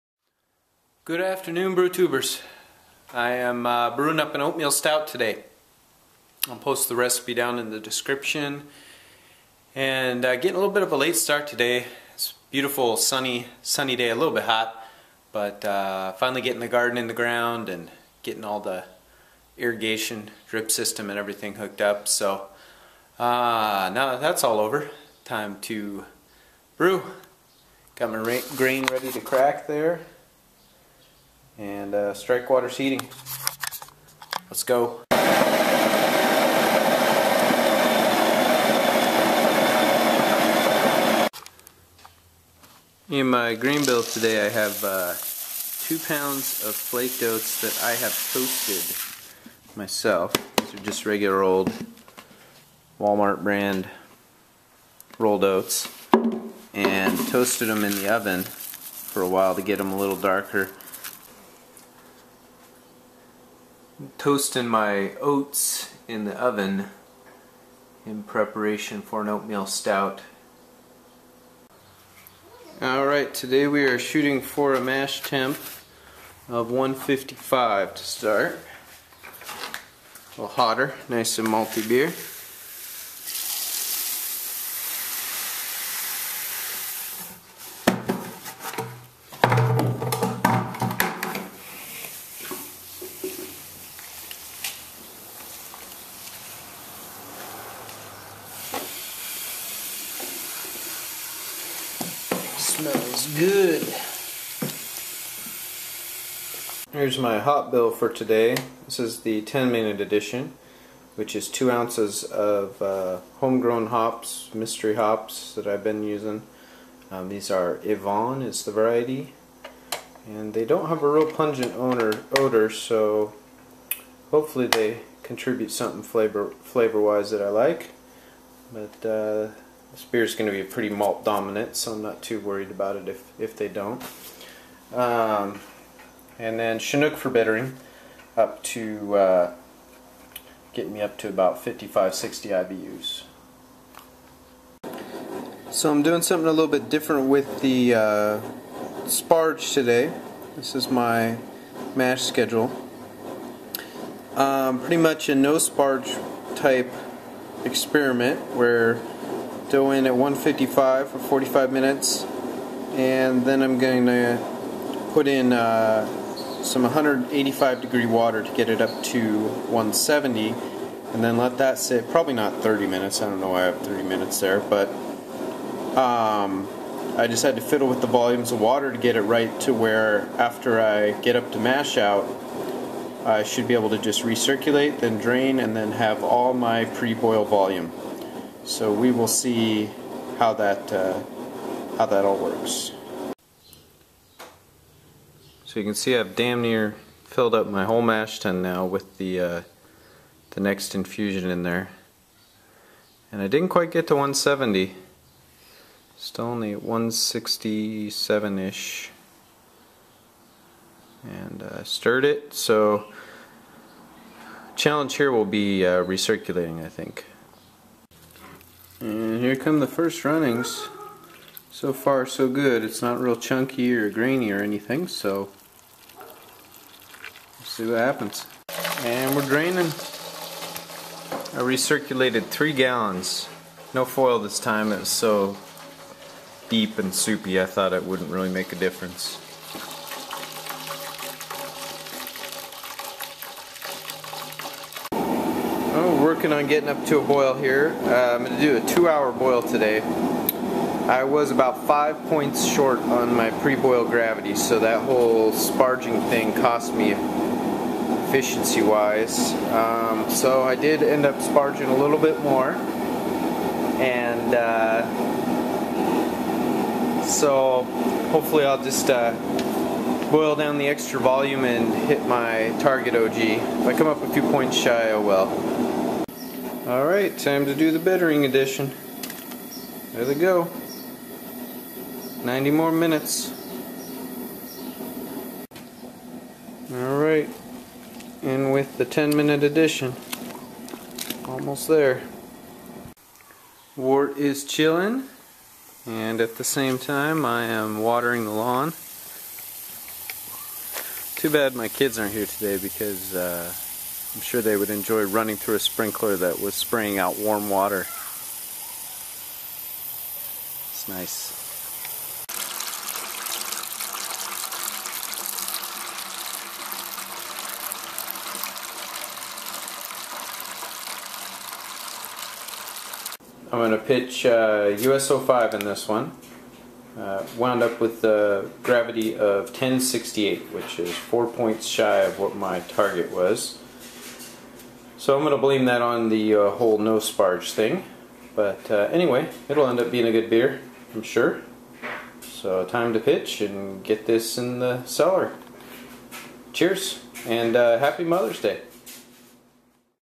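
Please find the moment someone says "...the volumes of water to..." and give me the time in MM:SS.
02:58.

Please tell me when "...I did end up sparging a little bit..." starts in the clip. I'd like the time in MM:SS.
04:20.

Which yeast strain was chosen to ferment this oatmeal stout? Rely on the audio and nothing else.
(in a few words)
US-05.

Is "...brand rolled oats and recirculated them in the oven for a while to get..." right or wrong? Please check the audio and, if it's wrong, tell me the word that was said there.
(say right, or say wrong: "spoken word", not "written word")
wrong: "toasted", not "recirculated".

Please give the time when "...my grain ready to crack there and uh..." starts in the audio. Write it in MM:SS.
00:28.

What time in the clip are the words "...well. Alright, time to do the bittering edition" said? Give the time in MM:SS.
04:35.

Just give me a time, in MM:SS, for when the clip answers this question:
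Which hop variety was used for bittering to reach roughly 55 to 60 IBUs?
02:16.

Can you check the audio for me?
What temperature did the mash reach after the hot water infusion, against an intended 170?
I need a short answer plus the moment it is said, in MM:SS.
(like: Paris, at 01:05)
167, at 03:26.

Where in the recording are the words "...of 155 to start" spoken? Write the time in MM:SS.
01:16.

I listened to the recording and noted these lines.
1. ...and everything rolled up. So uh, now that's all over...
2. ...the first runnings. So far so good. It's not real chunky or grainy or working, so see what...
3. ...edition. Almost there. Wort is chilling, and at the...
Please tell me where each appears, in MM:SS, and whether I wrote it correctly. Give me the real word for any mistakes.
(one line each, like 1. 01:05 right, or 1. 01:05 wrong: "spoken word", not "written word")
1. 00:21 wrong: "hooked", not "rolled"
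2. 03:39 wrong: "anything", not "working"
3. 04:49 right.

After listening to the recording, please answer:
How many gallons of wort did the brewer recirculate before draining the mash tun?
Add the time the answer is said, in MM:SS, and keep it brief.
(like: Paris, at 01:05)
3 gallons, at 03:52.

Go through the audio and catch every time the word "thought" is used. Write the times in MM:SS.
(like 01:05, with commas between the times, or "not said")
03:57.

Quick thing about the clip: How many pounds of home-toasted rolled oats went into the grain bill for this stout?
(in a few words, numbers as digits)
2 pounds.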